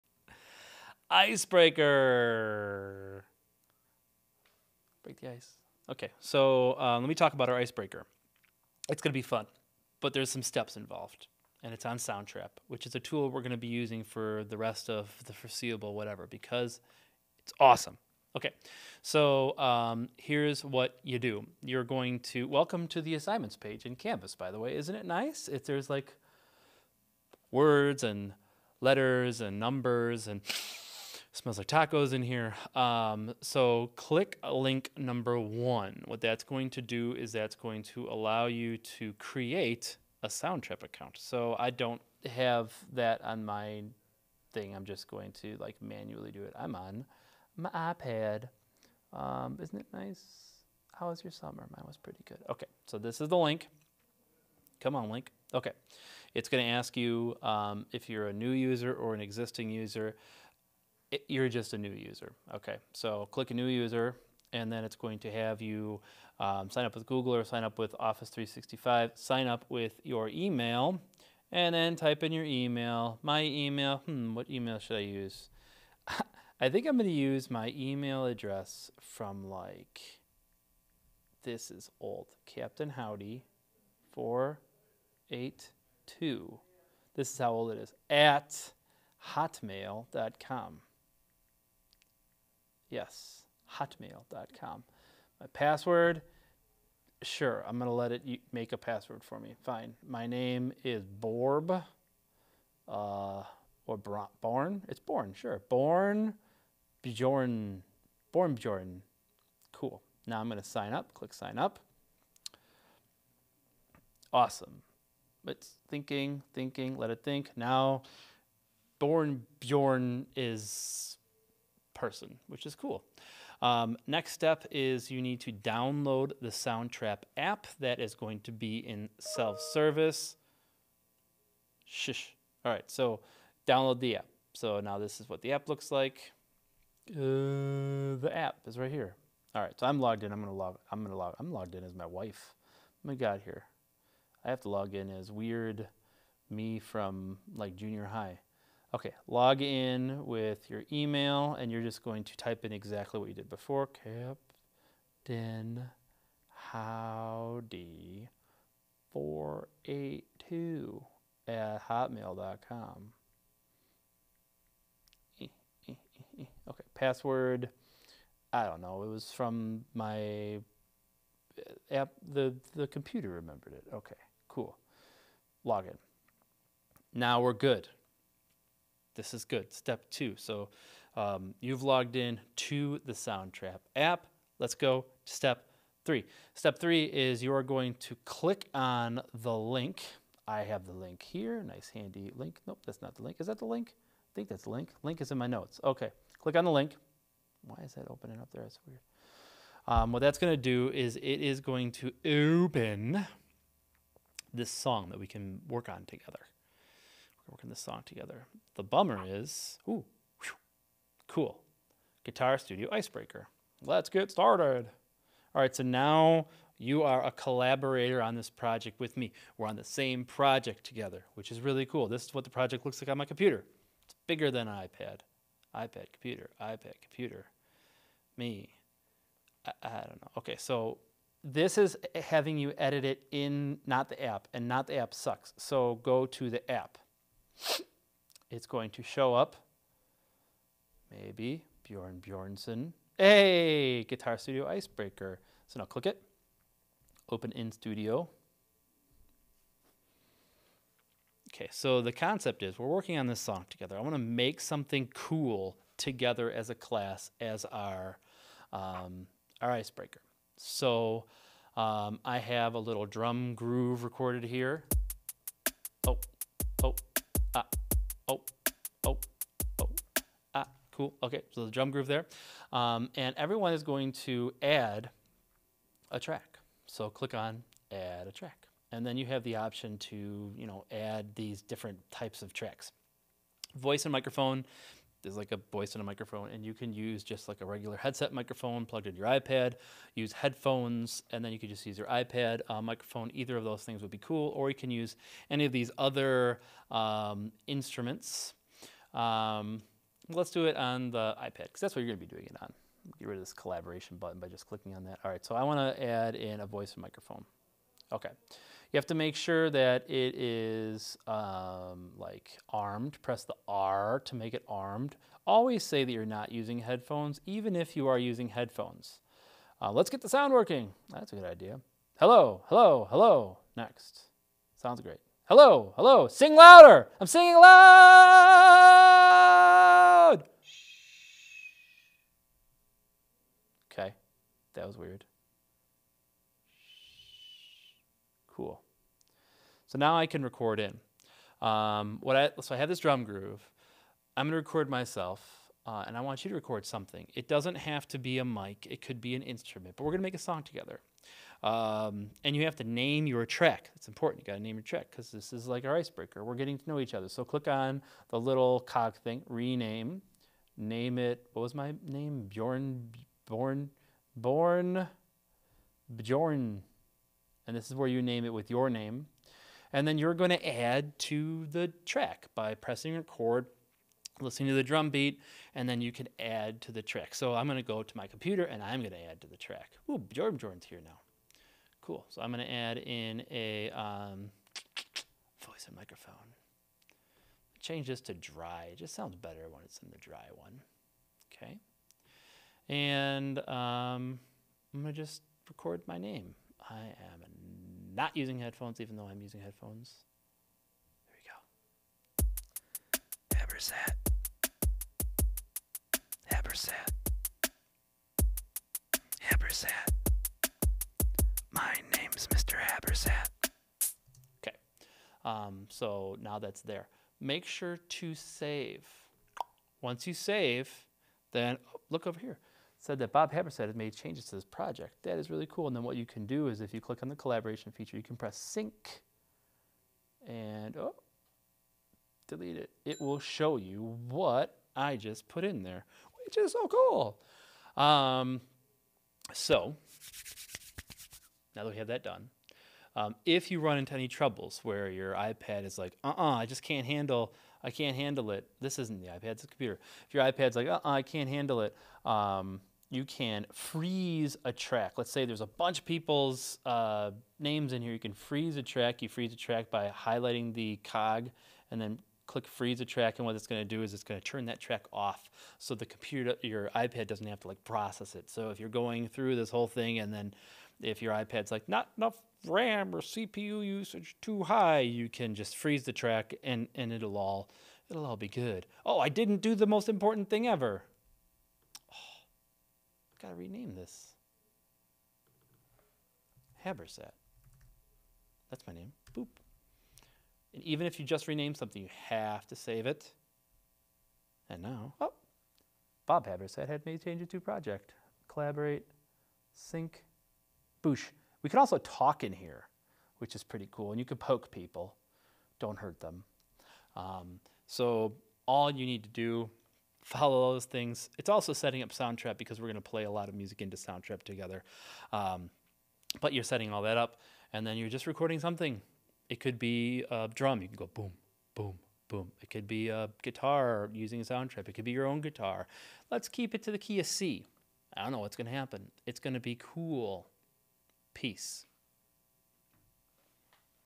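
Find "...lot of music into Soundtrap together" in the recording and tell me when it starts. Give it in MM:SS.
08:33.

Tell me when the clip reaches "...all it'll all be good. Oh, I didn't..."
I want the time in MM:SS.
07:57.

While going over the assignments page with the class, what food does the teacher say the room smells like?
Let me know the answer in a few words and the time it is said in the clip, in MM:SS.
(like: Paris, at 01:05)
Tacos, at 00:31.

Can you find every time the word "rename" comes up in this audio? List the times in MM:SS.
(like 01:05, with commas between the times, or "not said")
05:59, 08:03, 08:11.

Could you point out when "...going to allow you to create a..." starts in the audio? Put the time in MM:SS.
00:37.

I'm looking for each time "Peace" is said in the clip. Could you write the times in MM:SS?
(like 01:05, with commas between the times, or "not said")
08:51.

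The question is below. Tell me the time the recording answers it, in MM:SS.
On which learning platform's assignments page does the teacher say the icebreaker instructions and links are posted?
00:23.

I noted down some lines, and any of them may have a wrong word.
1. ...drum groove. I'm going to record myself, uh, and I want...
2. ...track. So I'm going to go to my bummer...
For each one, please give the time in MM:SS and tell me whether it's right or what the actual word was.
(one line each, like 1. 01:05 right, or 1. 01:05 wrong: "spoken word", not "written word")
1. 05:42 right
2. 06:17 wrong: "computer", not "bummer".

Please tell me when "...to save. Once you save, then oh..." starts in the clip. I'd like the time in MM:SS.
06:57.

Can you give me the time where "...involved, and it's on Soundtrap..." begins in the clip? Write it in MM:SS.
00:10.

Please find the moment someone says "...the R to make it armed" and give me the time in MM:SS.
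05:13.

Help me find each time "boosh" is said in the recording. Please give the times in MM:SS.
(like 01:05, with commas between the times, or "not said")
08:21.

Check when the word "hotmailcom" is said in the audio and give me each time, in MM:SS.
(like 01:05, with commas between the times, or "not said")
01:29, 01:33, 02:41.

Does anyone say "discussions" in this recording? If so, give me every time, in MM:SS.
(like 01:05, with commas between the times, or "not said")
not said.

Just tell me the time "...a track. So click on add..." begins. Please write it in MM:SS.
04:36.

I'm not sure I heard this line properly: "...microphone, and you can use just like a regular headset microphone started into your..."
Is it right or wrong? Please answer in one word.
wrong.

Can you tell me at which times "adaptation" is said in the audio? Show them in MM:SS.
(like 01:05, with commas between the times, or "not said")
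not said.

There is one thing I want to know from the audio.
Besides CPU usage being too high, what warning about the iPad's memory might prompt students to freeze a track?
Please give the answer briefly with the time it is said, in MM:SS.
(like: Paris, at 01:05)
Not enough RAM, at 07:51.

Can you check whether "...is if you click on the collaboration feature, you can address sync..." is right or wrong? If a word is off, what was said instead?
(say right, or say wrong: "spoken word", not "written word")
wrong: "press", not "address".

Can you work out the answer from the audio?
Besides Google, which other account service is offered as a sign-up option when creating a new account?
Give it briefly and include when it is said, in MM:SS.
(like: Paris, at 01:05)
Office 365, at 01:07.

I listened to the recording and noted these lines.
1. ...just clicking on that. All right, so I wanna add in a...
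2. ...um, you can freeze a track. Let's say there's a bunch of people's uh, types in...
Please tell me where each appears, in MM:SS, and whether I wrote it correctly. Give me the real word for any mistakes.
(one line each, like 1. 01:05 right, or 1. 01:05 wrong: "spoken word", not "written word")
1. 05:04 right
2. 07:32 wrong: "names", not "types".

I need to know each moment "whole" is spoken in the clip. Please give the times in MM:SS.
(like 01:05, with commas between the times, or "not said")
07:49.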